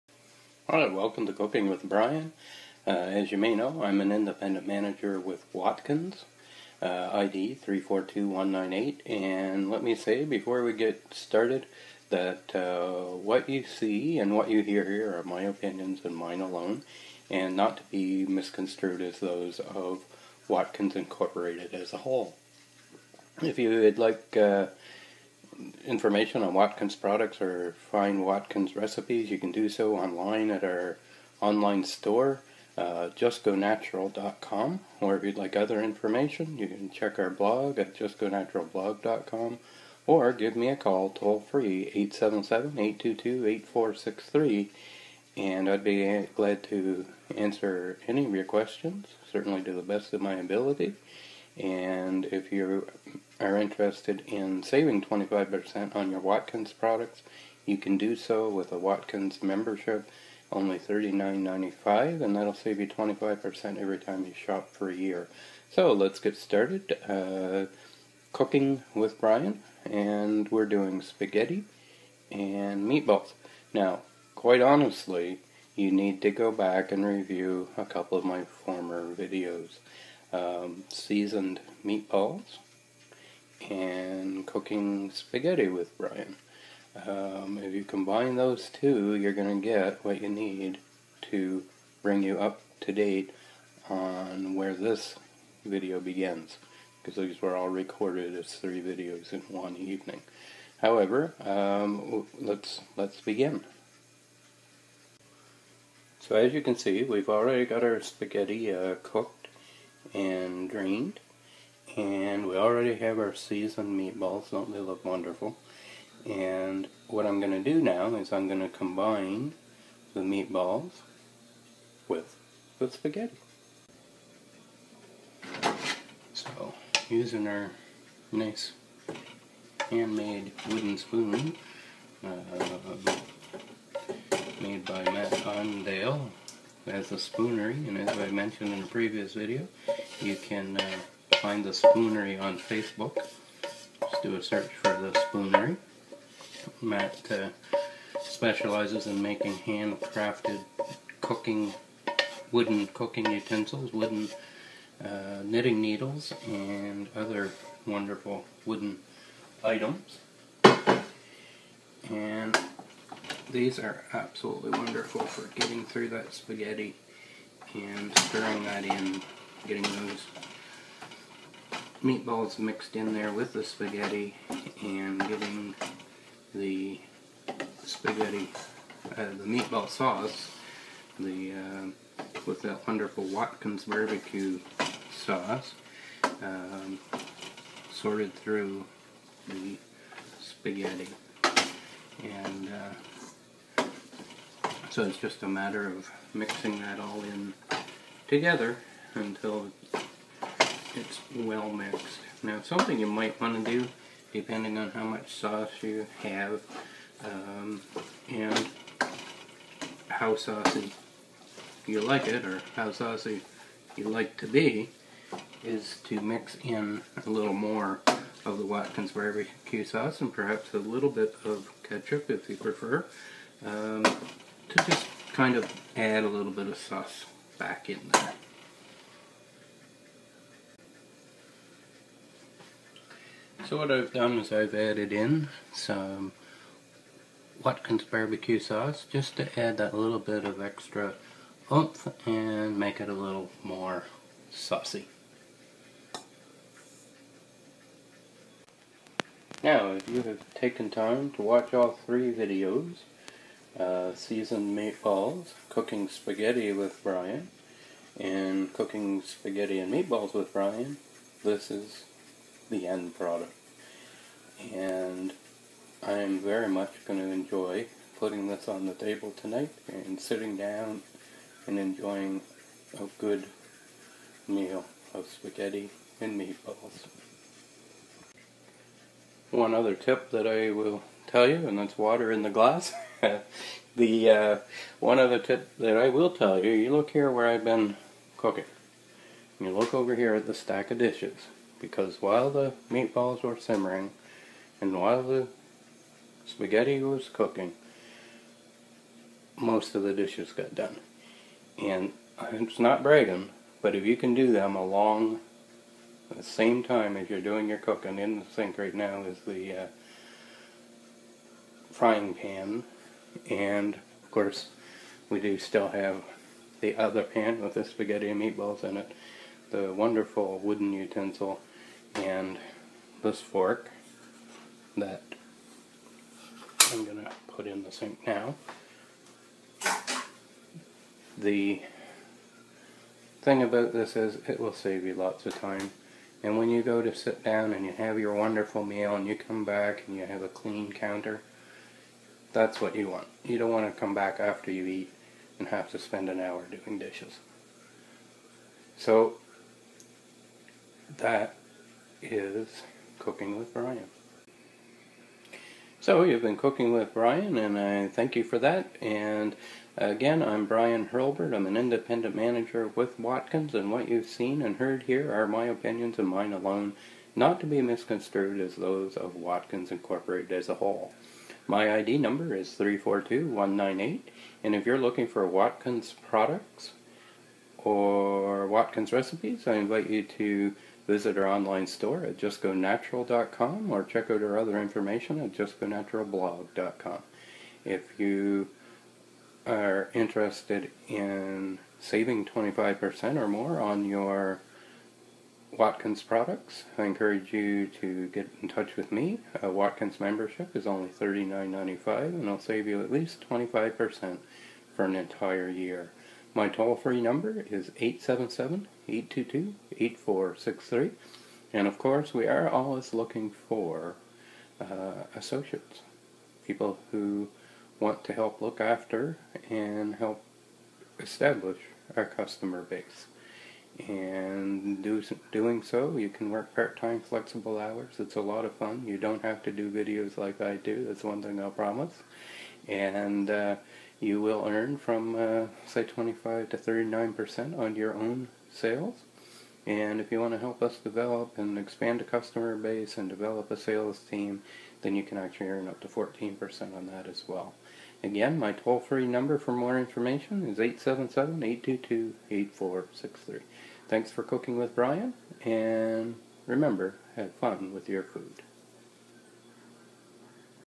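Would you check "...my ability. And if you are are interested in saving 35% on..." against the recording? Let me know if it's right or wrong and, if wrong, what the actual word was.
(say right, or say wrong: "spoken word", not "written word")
wrong: "25", not "35".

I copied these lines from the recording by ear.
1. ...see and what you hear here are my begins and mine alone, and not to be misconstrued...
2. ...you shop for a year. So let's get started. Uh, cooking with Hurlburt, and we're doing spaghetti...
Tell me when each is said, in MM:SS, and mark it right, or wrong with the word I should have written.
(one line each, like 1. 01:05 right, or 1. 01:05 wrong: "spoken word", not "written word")
1. 00:13 wrong: "opinions", not "begins"
2. 01:04 wrong: "Brian", not "Hurlburt".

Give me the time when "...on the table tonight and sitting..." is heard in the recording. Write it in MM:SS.
04:28.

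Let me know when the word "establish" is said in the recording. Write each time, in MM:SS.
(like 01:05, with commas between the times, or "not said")
07:01.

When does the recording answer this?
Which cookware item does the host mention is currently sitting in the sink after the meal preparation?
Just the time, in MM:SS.
05:11.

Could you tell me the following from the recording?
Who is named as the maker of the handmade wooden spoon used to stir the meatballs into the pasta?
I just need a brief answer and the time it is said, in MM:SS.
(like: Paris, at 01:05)
Matt Ondale, at 02:15.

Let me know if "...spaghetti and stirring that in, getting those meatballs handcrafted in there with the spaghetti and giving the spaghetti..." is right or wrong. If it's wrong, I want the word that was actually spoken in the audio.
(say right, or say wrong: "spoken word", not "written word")
wrong: "mixed", not "handcrafted".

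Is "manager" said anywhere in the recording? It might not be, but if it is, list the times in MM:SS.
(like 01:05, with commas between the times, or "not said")
00:04, 06:02.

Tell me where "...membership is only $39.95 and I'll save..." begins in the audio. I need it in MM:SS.
06:40.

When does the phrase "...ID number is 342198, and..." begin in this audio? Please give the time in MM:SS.
06:11.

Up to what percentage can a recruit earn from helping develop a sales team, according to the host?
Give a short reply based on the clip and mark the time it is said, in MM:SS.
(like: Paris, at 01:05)
14%, at 07:26.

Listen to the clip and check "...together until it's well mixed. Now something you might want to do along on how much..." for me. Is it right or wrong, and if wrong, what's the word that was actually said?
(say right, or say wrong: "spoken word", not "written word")
wrong: "depending", not "along".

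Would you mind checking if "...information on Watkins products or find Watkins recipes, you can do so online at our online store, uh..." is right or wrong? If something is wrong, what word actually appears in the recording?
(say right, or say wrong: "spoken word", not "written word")
right.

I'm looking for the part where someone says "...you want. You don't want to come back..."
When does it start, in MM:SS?
05:42.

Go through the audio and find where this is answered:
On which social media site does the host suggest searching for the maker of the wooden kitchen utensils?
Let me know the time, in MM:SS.
02:22.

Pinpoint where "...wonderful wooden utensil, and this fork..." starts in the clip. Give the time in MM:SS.
05:19.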